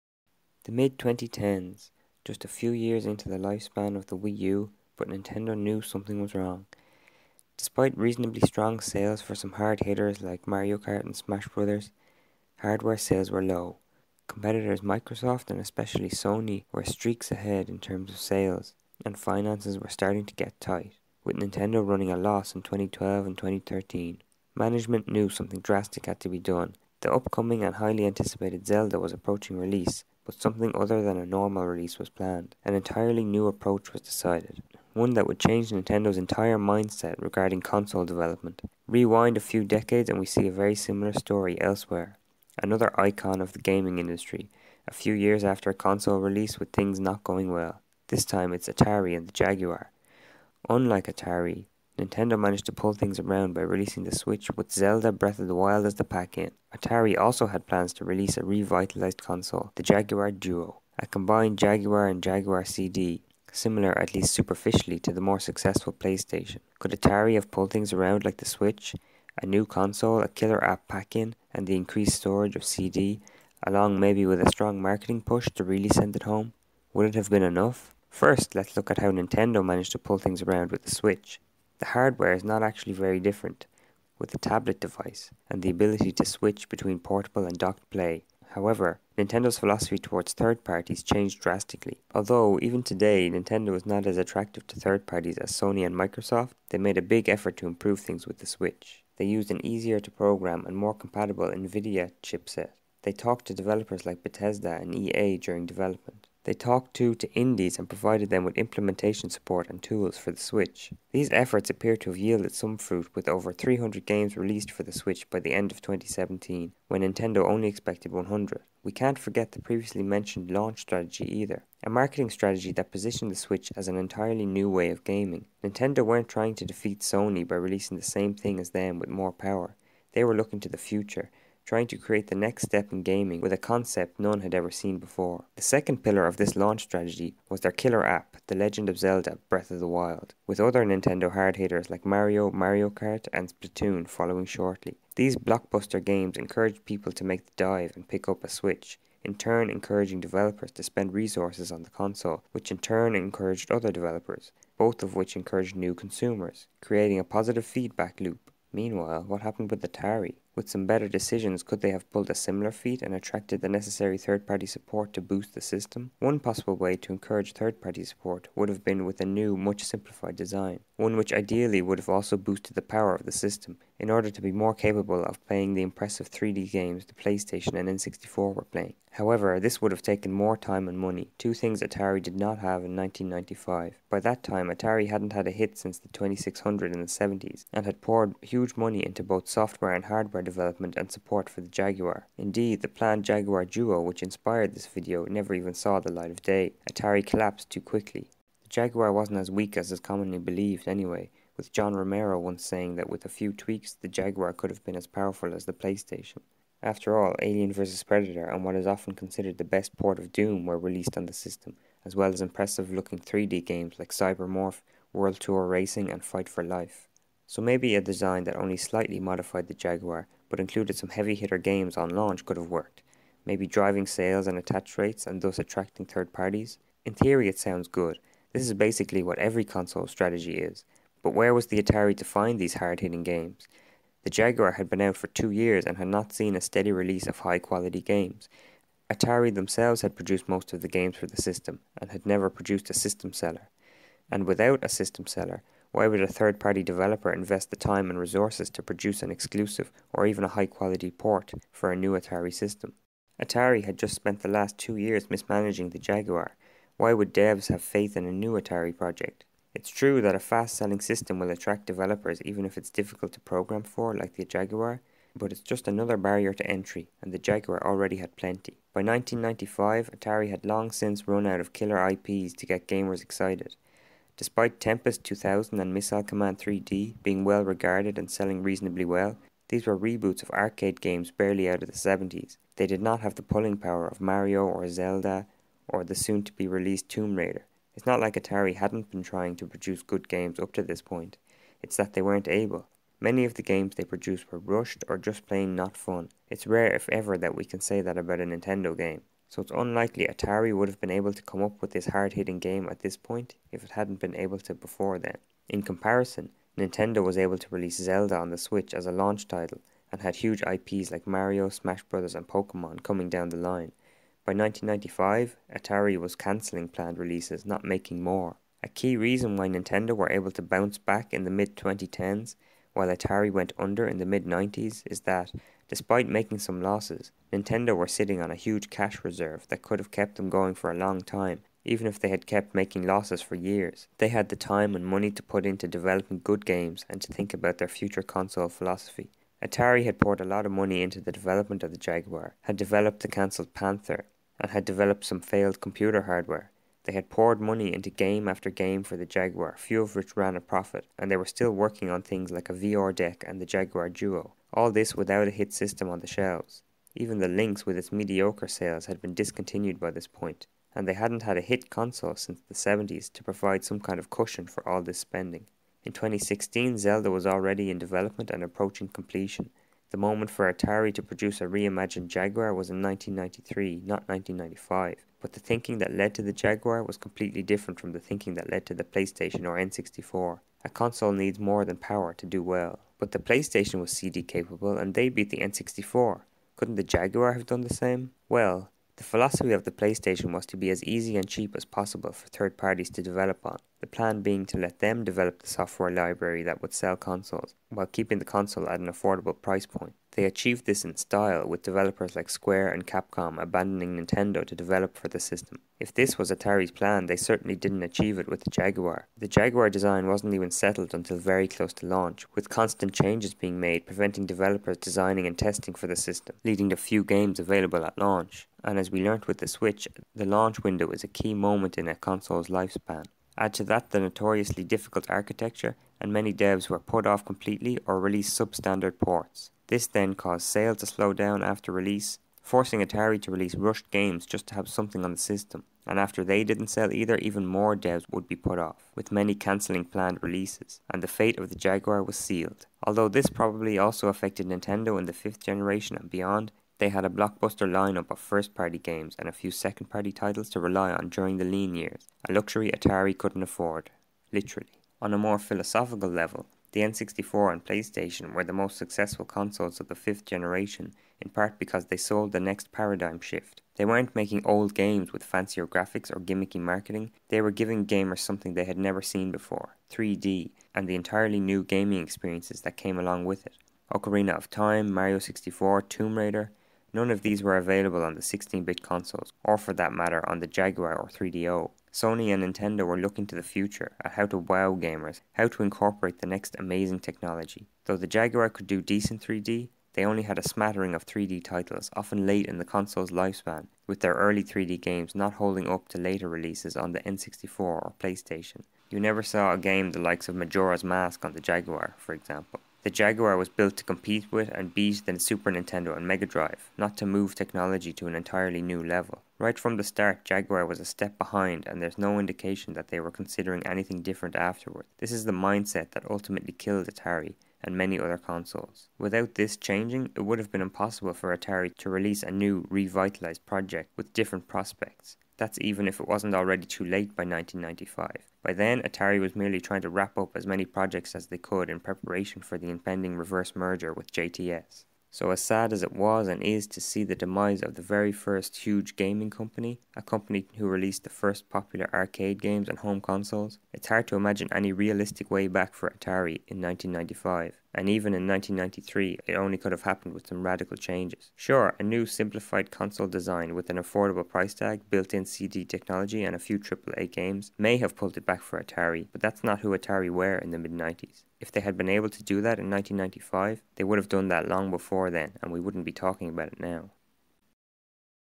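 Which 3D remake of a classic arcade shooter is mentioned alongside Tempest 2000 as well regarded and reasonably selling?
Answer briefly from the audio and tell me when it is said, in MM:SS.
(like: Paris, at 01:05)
Missile Command 3D, at 04:35.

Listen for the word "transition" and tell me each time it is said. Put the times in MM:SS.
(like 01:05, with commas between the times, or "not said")
not said.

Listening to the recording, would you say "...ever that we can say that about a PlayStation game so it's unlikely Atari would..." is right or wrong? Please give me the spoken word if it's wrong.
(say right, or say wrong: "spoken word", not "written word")
wrong: "Nintendo", not "PlayStation".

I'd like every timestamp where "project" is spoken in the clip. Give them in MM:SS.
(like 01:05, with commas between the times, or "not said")
04:18, 08:43, 08:50.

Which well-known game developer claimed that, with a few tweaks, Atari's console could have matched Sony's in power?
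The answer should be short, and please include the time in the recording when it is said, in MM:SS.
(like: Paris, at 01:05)
John Romero, at 03:21.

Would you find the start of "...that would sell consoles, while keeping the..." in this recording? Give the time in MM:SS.
06:36.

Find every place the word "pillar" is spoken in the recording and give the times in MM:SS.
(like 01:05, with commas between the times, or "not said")
02:16.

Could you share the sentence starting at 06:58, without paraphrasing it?
And as we learnt with the Switch, the launch window is a key moment in a console's lifespan.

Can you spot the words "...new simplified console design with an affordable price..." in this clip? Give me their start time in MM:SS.
09:12.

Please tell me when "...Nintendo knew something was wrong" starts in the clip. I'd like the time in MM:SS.
00:05.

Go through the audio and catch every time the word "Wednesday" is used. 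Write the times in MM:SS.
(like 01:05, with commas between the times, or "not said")
not said.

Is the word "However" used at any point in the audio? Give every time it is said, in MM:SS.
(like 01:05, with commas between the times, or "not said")
01:28, 02:59.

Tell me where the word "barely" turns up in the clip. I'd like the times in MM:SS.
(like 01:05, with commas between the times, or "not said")
04:41.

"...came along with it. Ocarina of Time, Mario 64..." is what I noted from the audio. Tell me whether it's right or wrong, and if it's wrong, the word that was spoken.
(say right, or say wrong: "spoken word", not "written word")
right.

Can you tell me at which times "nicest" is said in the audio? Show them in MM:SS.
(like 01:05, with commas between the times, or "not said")
not said.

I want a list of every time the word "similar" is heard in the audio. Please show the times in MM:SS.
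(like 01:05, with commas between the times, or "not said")
00:40, 01:03, 02:42.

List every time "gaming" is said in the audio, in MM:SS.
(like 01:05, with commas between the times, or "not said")
00:43, 02:05, 02:13, 07:51, 08:59.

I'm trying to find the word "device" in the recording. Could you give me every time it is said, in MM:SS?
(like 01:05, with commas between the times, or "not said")
01:24.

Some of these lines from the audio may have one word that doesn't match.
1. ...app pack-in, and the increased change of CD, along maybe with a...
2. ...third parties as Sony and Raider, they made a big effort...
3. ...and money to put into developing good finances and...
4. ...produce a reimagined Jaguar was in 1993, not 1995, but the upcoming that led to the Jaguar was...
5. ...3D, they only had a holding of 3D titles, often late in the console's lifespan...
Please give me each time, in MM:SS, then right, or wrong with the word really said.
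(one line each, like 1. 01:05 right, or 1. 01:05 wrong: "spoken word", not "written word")
1. 01:10 wrong: "storage", not "change"
2. 01:34 wrong: "Microsoft", not "Raider"
3. 05:34 wrong: "games", not "finances"
4. 06:11 wrong: "thinking", not "upcoming"
5. 08:09 wrong: "smattering", not "holding".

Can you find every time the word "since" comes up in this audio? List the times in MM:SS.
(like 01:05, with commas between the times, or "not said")
03:05, 04:30, 06:02.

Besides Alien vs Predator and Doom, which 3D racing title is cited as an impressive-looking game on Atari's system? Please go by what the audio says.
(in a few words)
World Tour Racing.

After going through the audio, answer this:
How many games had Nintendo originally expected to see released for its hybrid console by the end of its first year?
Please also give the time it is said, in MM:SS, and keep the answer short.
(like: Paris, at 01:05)
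100, at 01:58.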